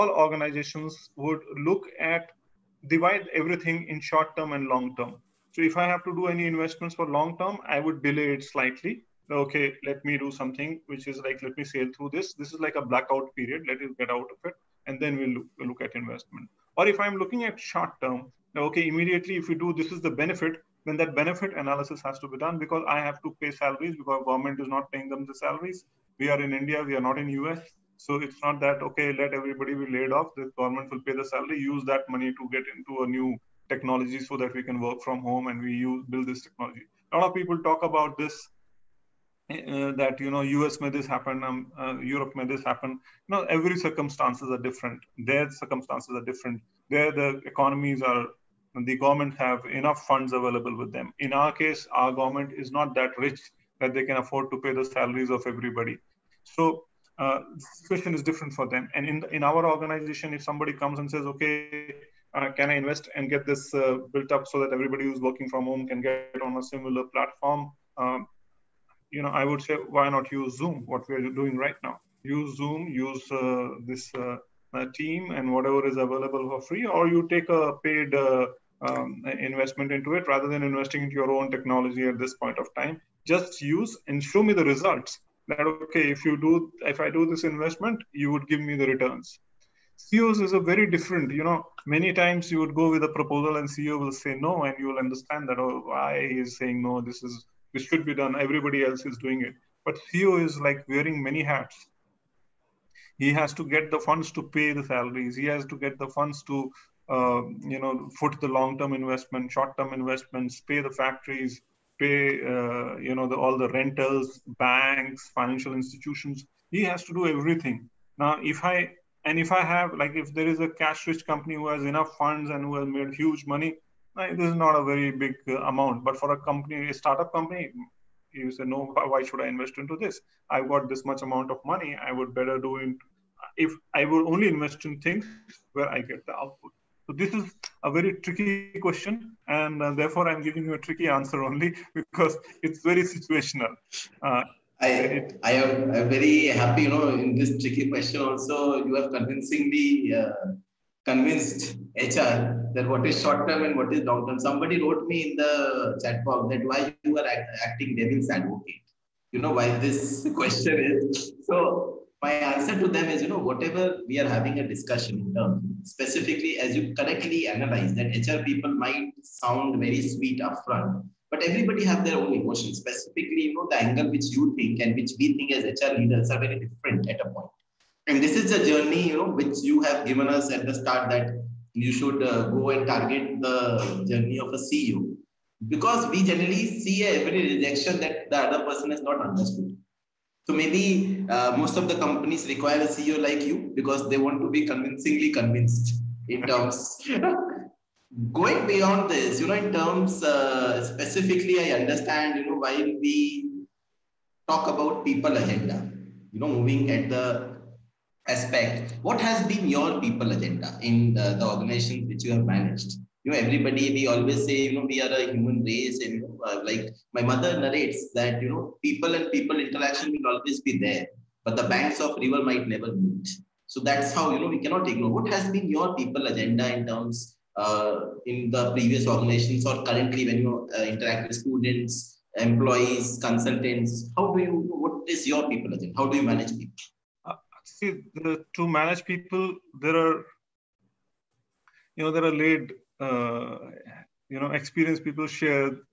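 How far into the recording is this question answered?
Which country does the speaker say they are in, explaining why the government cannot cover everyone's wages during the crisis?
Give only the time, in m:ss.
0:26.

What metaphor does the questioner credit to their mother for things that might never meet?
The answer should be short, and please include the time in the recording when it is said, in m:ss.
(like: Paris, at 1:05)
banks of river, at 3:41.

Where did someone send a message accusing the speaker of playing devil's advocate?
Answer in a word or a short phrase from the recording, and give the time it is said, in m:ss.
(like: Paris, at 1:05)
chat box, at 2:36.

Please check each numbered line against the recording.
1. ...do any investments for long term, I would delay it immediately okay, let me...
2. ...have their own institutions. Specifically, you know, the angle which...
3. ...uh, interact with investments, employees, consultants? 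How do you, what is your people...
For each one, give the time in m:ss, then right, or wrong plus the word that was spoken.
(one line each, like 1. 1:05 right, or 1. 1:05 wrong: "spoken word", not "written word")
1. 0:06 wrong: "slightly", not "immediately"
2. 2:51 wrong: "emotions", not "institutions"
3. 3:50 wrong: "students", not "investments".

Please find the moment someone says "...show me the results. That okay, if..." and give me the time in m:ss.
1:24.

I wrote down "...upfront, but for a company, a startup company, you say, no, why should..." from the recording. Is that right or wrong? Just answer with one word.
wrong.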